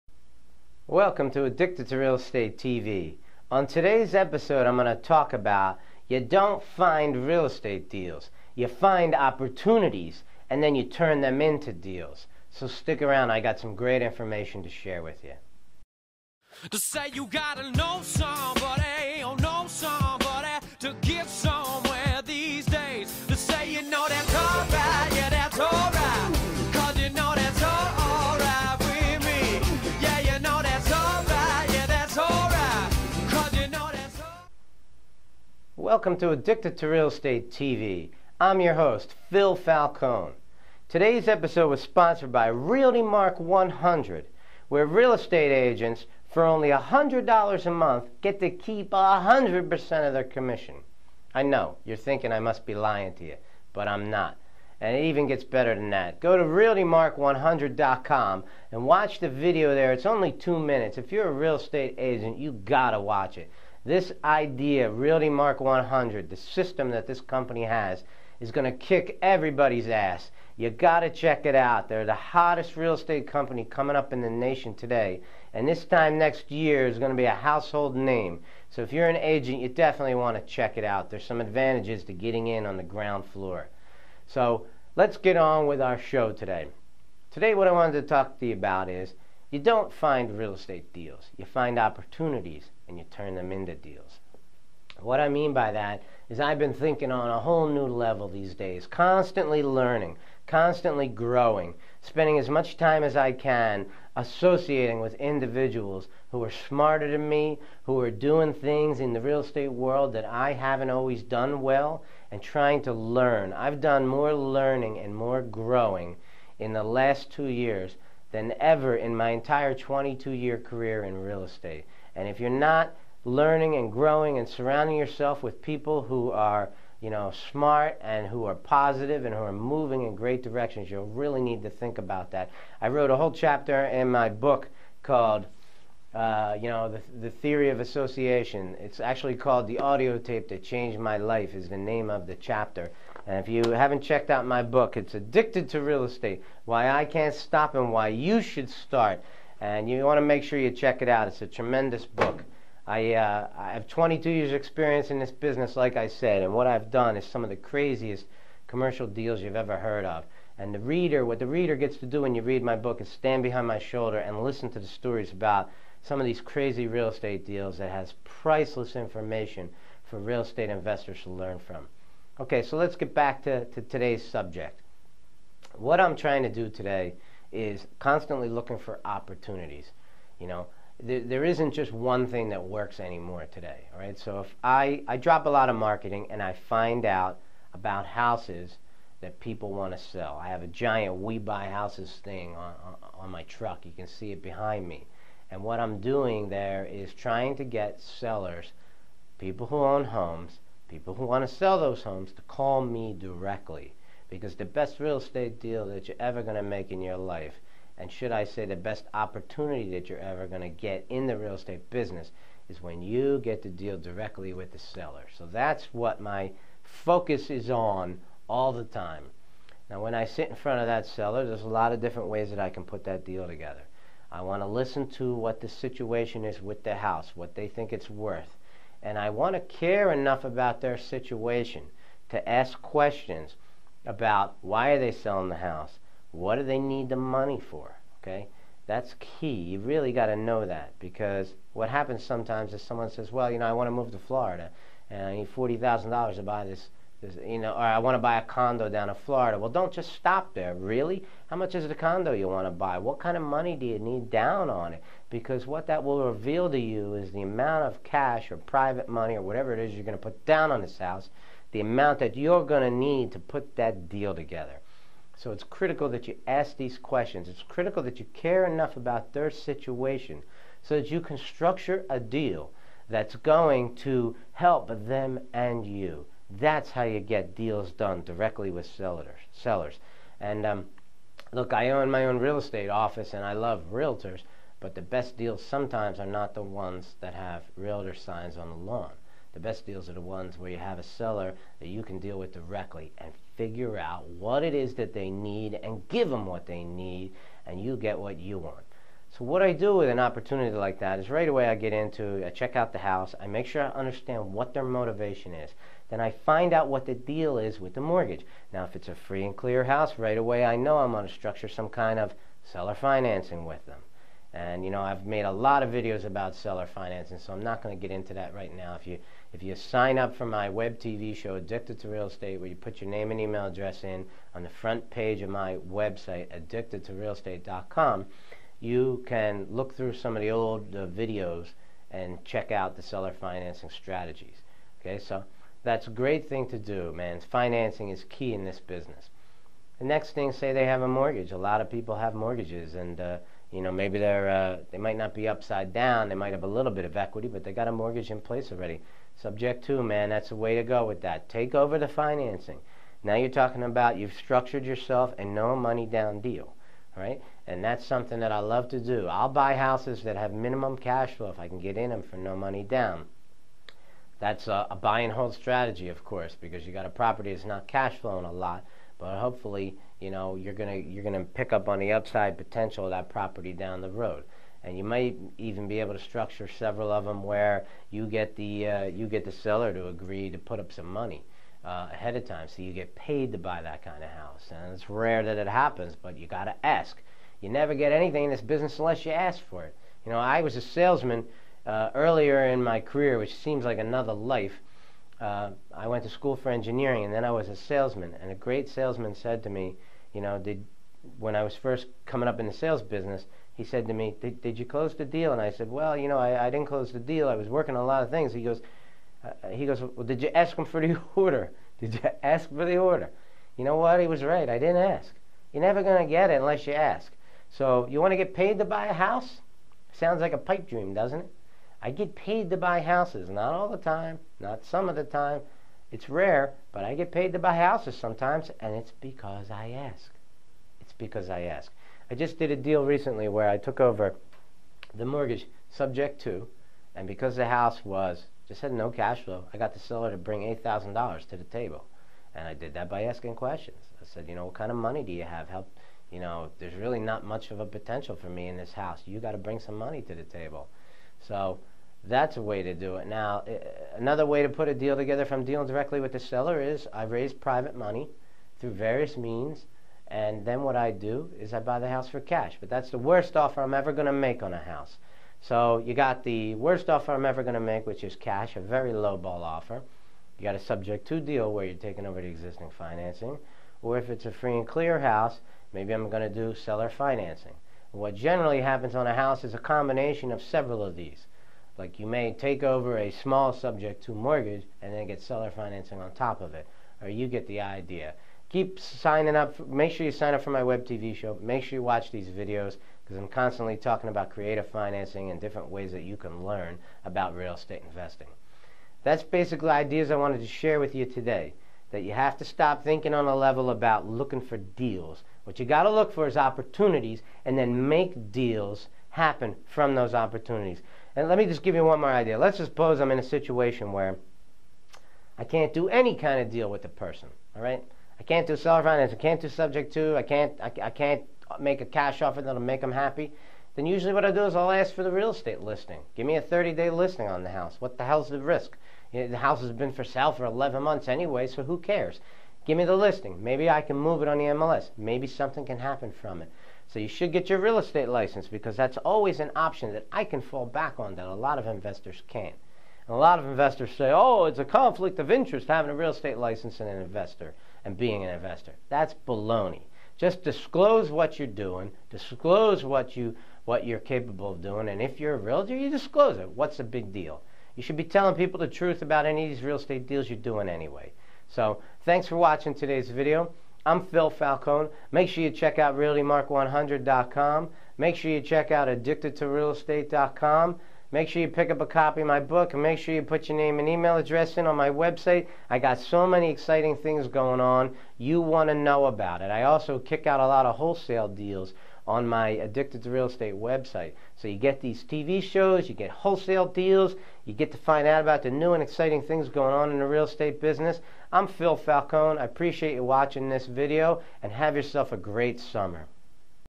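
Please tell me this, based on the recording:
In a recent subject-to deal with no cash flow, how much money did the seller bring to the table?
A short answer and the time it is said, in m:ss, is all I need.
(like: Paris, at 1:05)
$8,000, at 7:20.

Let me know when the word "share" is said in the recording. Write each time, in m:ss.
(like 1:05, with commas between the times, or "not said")
0:14, 8:20.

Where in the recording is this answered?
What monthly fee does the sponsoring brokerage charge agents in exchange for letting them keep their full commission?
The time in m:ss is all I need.
0:46.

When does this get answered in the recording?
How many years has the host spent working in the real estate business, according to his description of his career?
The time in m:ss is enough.
1:59.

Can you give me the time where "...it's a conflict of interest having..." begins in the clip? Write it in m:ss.
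9:04.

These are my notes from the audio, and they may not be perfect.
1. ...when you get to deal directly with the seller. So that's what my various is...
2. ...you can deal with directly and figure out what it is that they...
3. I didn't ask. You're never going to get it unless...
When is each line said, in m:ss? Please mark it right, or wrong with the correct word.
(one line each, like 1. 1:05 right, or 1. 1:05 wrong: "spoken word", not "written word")
1. 3:32 wrong: "focus", not "various"
2. 4:51 right
3. 6:54 right.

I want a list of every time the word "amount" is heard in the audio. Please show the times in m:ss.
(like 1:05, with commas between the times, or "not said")
4:17, 4:21.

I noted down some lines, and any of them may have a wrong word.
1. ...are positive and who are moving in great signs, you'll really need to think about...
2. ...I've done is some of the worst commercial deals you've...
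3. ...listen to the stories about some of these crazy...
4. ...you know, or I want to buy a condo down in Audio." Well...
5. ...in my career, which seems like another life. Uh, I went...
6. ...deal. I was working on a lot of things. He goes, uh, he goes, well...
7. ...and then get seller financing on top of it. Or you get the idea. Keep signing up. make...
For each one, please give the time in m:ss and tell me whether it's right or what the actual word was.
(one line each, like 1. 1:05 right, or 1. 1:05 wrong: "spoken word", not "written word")
1. 2:08 wrong: "directions", not "signs"
2. 2:36 wrong: "craziest", not "worst"
3. 2:44 right
4. 4:07 wrong: "Florida", not "Audio"
5. 6:32 right
6. 6:47 right
7. 8:05 right.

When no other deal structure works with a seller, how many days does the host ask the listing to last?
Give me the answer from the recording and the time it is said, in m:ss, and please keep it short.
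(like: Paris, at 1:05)
30, at 8:46.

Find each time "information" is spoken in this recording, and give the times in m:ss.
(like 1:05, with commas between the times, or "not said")
0:14, 2:48.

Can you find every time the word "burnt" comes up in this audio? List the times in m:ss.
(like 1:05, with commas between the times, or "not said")
not said.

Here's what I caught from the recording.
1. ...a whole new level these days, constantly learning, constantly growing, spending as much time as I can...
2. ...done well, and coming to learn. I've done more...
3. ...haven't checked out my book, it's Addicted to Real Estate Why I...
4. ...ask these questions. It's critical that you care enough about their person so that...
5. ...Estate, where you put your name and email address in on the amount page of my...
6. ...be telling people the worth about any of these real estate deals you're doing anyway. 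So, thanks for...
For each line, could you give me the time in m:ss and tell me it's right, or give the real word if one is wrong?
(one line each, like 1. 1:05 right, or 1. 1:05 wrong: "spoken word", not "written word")
1. 1:37 right
2. 1:51 wrong: "trying", not "coming"
3. 2:23 right
4. 4:26 wrong: "situation", not "person"
5. 5:22 wrong: "front", not "amount"
6. 9:18 wrong: "truth", not "worth".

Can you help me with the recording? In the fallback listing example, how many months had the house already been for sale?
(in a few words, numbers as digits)
11.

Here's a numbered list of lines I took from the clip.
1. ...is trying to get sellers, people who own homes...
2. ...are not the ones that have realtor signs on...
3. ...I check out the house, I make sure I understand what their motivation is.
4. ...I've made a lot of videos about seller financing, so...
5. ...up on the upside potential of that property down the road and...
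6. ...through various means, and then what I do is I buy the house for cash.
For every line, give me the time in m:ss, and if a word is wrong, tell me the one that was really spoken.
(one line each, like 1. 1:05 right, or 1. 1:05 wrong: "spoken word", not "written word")
1. 3:16 right
2. 4:46 right
3. 5:02 right
4. 5:15 right
5. 6:11 right
6. 7:38 right.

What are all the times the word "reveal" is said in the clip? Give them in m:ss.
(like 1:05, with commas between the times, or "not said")
4:16.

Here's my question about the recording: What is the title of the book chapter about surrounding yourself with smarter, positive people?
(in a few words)
The Audio Tape That Changed My Life.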